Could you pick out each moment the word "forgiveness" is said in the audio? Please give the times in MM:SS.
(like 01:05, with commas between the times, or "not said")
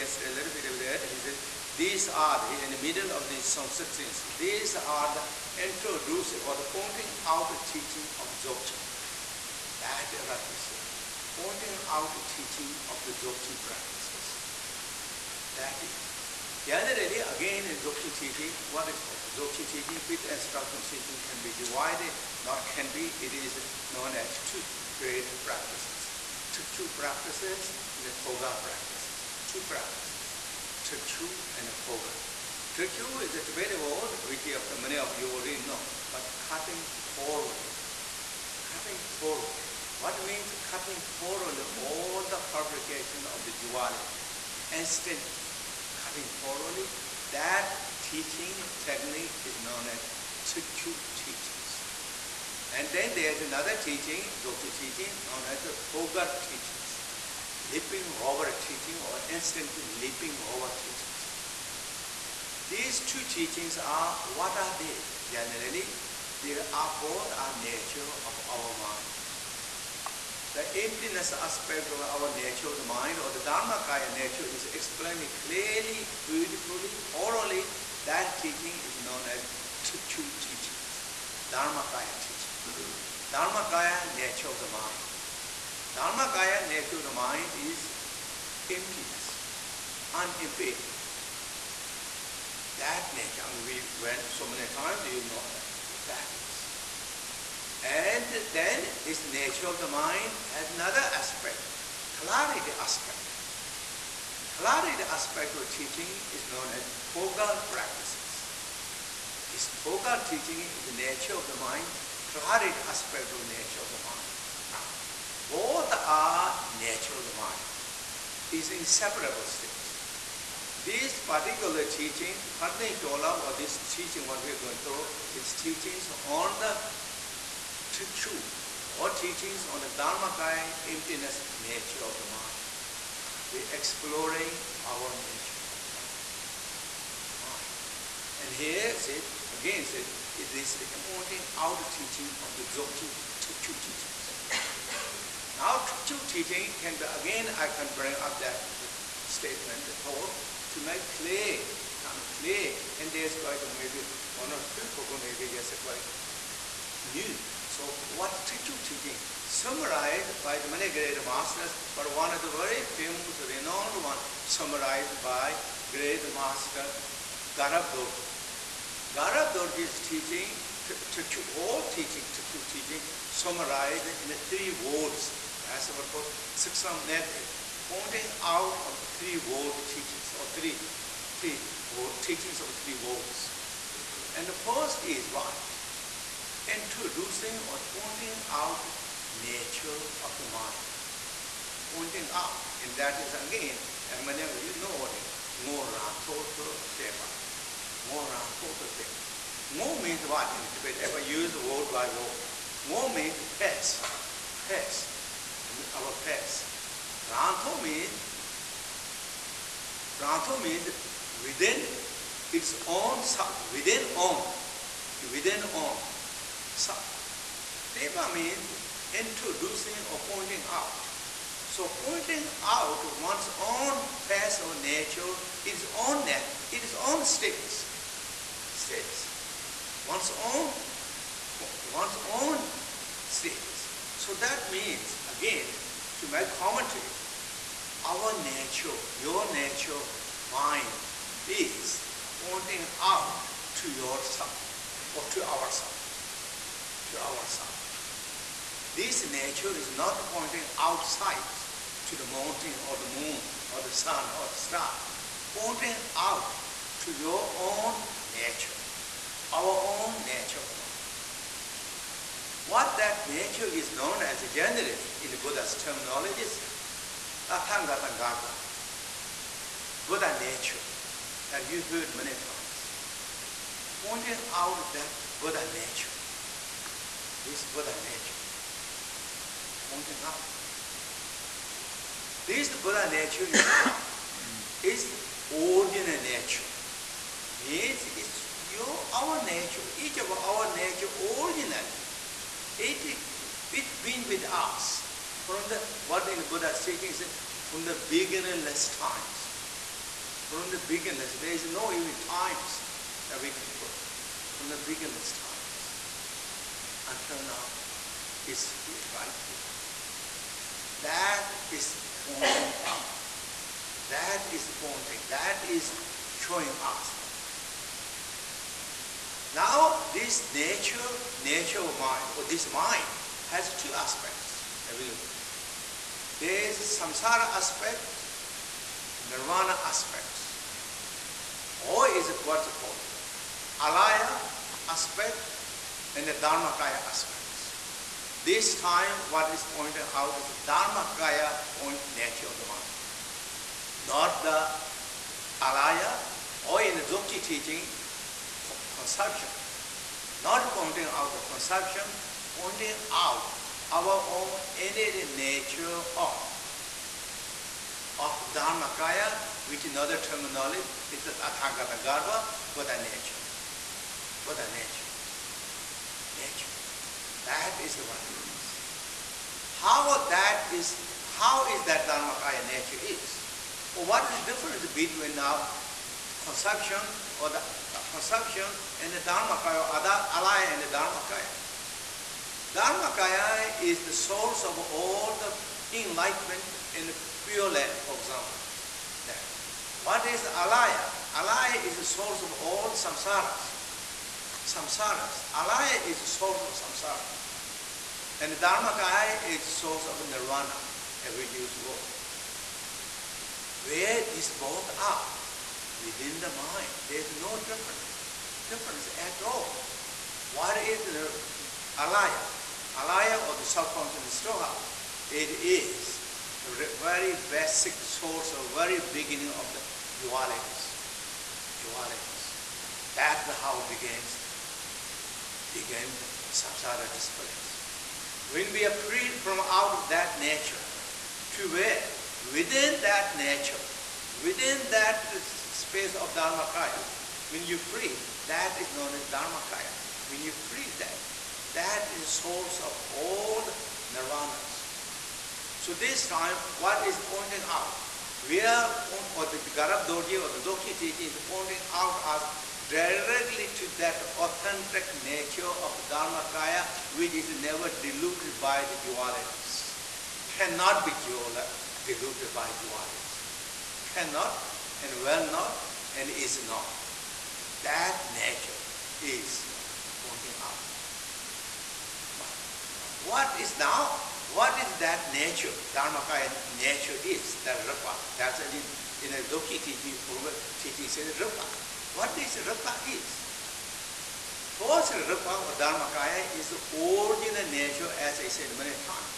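not said.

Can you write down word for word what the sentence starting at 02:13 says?
We're exploring our nature of the mind.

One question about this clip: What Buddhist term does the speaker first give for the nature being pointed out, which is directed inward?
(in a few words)
Garbha.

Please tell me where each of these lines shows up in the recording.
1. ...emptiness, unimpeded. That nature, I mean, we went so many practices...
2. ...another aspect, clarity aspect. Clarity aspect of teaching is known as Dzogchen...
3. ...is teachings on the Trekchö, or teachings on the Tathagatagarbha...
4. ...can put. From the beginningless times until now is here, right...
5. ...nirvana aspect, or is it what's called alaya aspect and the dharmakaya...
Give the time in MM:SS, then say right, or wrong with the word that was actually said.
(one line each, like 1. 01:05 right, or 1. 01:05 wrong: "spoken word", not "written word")
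1. 01:28 wrong: "times", not "practices"
2. 01:40 wrong: "Tögal", not "Dzogchen"
3. 02:05 wrong: "Dharmakaya", not "Tathagatagarbha"
4. 05:03 right
5. 05:29 right.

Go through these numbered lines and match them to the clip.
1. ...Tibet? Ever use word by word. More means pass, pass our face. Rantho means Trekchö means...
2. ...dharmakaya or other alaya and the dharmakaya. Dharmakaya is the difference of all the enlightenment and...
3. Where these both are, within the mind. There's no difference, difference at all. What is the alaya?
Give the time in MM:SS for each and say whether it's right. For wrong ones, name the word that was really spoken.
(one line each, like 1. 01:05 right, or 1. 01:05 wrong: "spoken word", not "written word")
1. 03:20 wrong: "Rantho", not "Trekchö"
2. 06:19 wrong: "source", not "difference"
3. 06:43 right.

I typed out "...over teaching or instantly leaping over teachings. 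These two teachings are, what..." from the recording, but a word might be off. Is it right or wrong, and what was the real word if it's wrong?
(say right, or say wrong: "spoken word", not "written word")
right.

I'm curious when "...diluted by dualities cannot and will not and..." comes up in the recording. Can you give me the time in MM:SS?
07:42.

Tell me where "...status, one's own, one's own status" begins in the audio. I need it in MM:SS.
03:48.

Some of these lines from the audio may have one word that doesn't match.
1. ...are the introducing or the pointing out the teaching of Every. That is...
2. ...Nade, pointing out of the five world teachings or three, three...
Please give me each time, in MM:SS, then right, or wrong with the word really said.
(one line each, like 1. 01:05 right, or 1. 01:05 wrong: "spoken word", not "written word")
1. 00:04 wrong: "Dzogchen", not "Every"
2. 02:57 wrong: "three", not "five".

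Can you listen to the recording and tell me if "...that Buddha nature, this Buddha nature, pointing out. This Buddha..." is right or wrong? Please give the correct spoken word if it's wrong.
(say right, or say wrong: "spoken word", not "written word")
right.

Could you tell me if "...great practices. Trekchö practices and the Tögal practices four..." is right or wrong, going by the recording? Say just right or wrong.
wrong.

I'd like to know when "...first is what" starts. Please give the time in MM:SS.
03:04.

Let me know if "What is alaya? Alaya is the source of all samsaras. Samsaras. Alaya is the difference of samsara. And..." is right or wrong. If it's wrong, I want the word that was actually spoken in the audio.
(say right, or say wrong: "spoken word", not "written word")
wrong: "source", not "difference".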